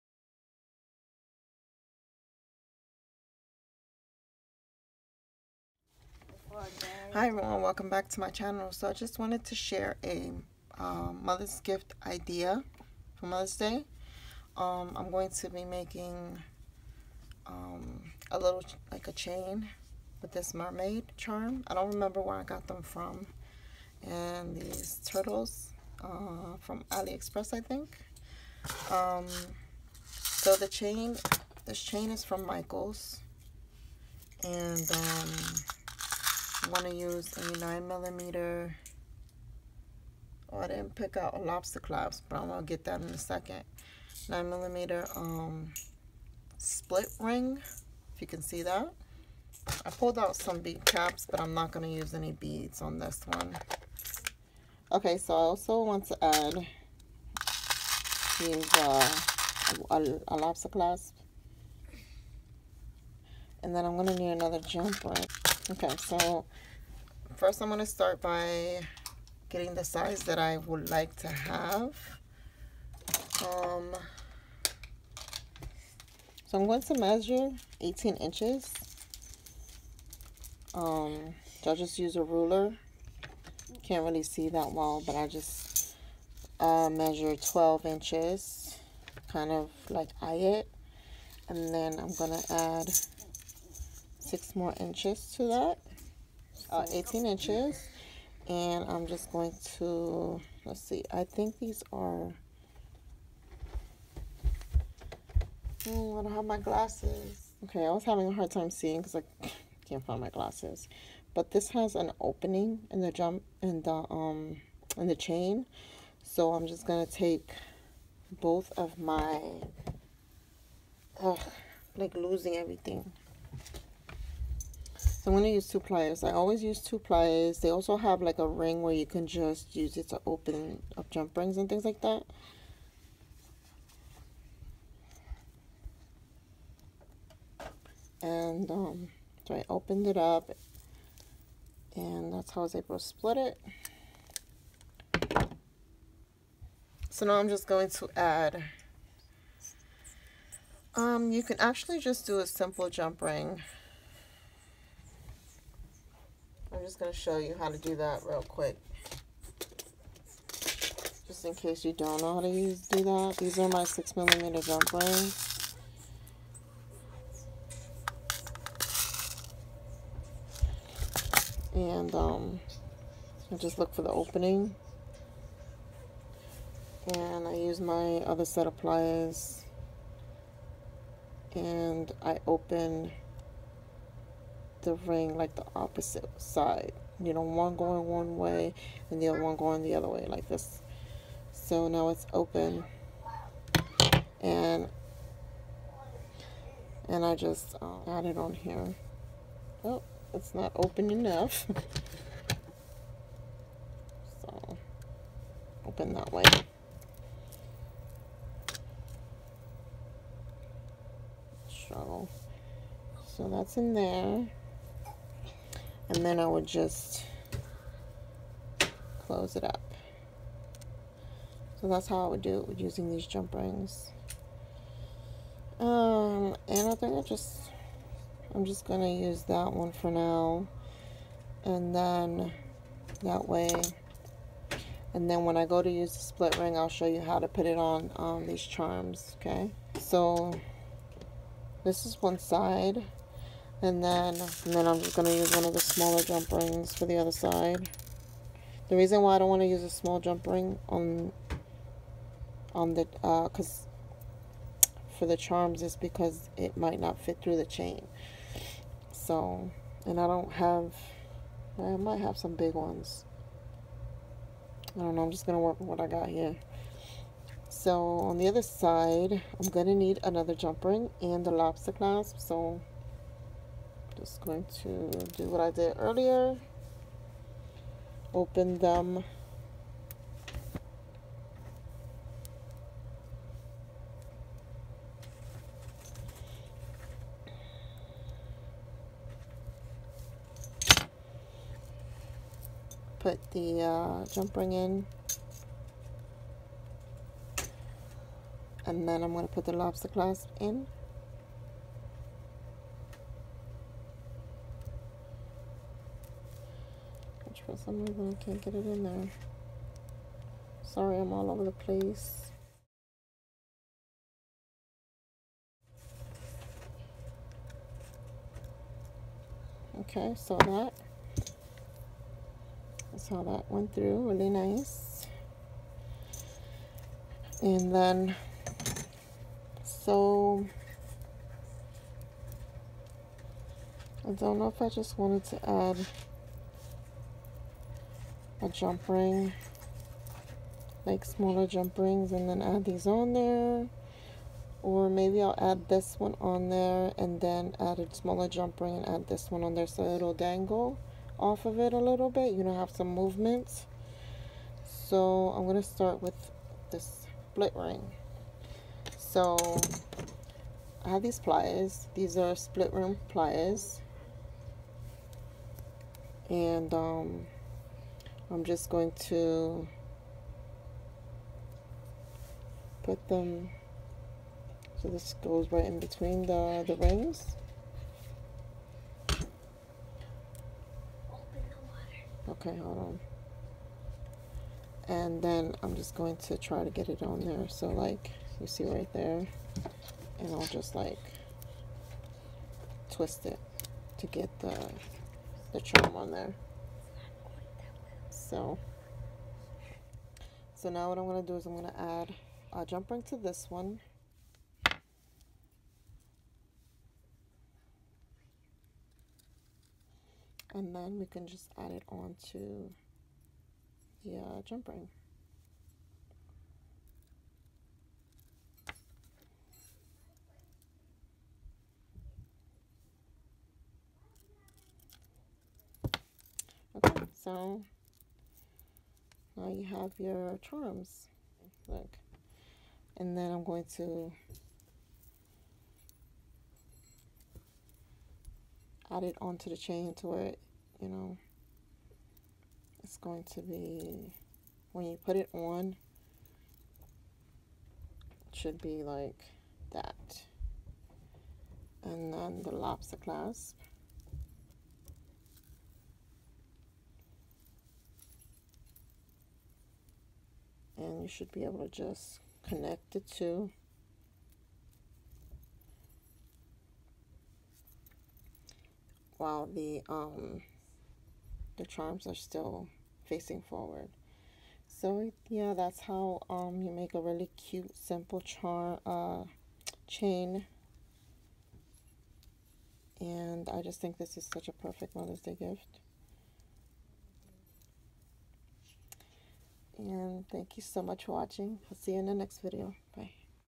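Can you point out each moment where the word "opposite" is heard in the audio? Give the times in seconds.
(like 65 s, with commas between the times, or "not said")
185 s.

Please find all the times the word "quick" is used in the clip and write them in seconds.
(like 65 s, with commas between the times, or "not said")
158 s.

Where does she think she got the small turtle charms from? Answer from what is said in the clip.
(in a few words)
AliExpress.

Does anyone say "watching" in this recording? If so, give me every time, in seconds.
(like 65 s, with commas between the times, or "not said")
491 s.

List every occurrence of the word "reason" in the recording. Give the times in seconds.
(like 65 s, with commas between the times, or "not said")
248 s, 308 s.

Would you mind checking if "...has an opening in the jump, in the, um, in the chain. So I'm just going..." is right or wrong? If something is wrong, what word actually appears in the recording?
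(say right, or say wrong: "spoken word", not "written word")
right.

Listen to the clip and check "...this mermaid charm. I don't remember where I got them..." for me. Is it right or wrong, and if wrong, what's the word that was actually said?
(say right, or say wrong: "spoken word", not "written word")
right.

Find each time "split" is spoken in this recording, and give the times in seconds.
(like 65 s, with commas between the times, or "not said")
46 s, 143 s, 236 s, 357 s, 362 s.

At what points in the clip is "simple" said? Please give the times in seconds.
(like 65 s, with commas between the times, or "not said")
152 s, 477 s.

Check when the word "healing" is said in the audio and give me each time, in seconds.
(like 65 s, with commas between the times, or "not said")
not said.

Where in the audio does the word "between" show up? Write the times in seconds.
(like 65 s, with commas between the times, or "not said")
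376 s.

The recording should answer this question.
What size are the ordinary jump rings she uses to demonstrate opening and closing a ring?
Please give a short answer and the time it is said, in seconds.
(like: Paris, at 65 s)
6 millimeter, at 163 s.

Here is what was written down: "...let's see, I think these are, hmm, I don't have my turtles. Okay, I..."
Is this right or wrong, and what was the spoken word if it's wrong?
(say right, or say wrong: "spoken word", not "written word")
wrong: "glasses", not "turtles".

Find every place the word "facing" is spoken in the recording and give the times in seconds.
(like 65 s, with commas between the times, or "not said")
473 s.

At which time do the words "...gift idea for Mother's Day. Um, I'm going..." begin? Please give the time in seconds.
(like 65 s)
11 s.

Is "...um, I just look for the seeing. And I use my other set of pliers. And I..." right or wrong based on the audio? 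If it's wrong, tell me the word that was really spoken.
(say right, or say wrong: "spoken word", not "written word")
wrong: "opening", not "seeing".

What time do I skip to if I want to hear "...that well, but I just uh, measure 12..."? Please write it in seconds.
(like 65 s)
84 s.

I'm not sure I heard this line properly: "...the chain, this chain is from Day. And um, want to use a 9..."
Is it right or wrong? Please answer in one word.
wrong.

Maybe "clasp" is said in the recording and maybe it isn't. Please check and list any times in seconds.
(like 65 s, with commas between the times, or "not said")
60 s, 271 s, 300 s, 453 s.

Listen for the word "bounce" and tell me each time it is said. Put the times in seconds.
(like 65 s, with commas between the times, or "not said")
not said.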